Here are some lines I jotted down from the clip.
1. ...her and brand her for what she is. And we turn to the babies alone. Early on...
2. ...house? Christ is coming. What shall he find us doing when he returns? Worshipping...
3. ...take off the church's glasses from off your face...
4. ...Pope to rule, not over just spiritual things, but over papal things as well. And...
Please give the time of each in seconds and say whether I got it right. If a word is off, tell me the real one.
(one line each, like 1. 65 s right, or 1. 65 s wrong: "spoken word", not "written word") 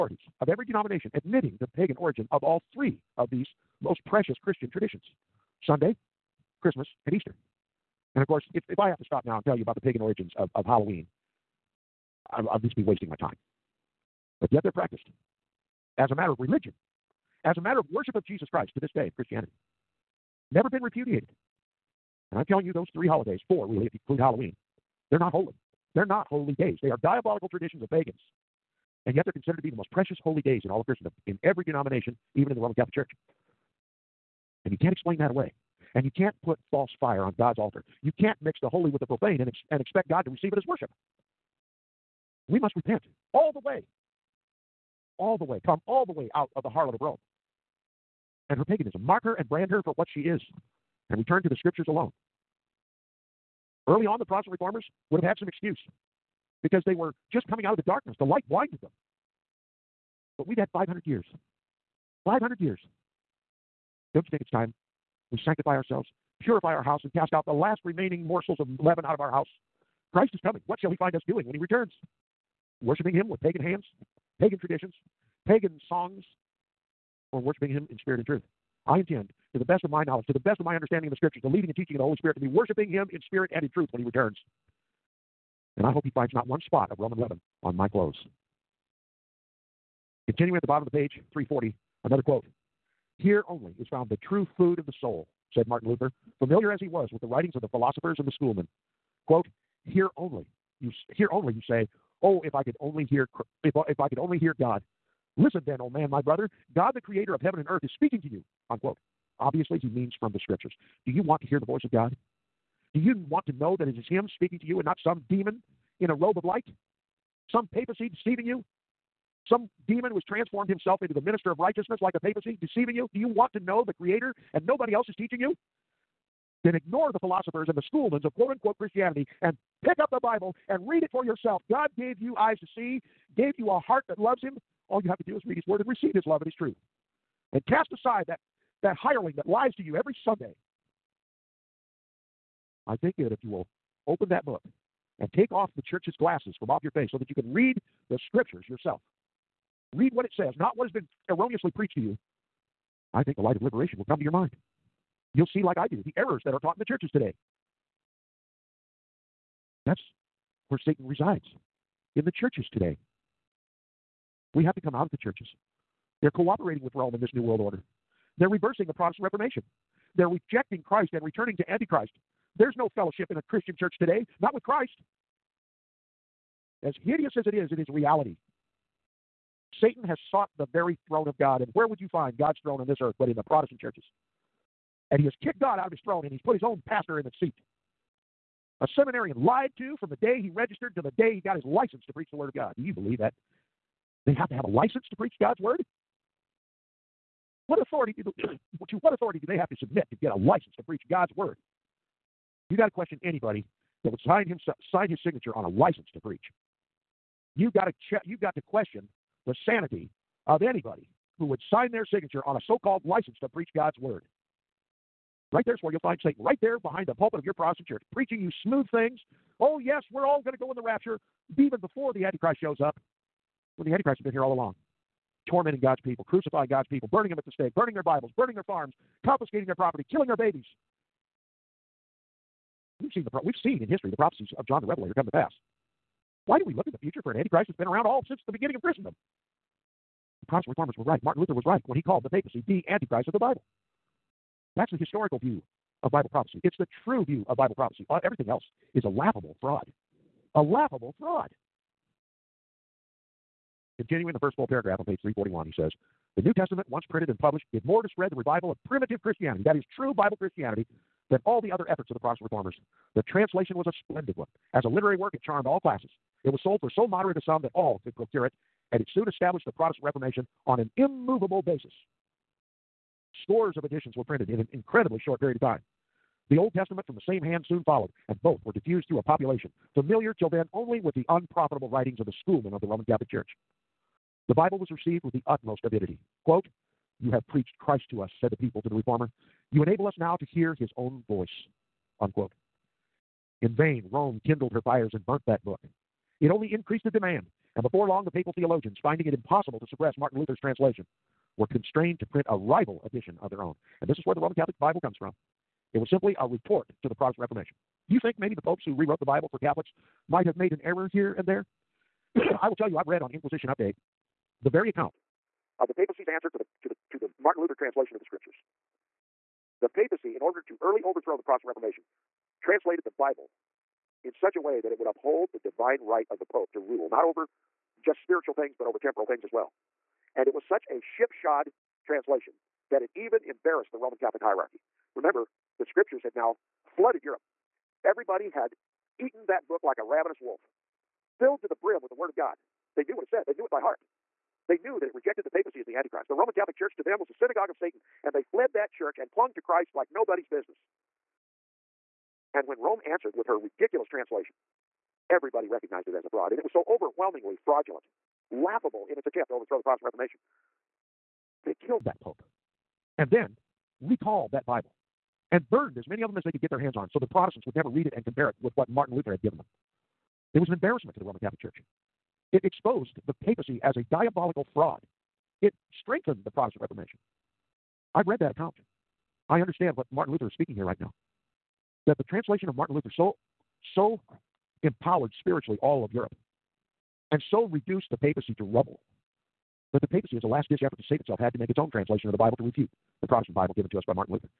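1. 49 s wrong: "scriptures", not "babies"
2. 69 s right
3. 145 s right
4. 326 s wrong: "temporal", not "papal".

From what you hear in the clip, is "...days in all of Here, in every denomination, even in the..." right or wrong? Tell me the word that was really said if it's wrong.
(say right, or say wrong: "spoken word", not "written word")
wrong: "Christendom", not "Here".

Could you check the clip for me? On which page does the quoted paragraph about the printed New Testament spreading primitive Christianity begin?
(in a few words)
341.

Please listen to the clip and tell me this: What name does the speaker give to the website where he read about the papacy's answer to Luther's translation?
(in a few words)
Inquisition Update.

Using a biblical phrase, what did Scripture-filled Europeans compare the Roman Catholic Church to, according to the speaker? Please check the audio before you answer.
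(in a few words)
Synagogue of Satan.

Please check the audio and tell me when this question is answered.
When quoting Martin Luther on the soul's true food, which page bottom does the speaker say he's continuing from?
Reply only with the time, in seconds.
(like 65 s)
91 s.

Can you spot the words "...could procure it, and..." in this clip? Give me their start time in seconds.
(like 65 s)
268 s.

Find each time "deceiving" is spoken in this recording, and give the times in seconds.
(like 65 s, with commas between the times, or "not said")
118 s, 122 s.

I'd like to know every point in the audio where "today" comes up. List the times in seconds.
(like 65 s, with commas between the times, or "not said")
157 s, 162 s, 173 s.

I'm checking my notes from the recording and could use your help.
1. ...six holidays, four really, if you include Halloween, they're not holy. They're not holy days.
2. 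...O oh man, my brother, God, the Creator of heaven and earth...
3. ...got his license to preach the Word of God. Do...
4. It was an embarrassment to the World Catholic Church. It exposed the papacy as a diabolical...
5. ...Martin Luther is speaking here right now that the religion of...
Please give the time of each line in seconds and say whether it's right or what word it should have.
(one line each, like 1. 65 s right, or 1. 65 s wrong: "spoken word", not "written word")
1. 22 s wrong: "three", not "six"
2. 105 s right
3. 191 s right
4. 370 s wrong: "Roman", not "World"
5. 380 s wrong: "translation", not "religion".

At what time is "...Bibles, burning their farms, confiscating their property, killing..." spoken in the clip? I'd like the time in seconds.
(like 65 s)
228 s.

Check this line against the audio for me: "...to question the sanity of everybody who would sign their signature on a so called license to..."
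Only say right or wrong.
wrong.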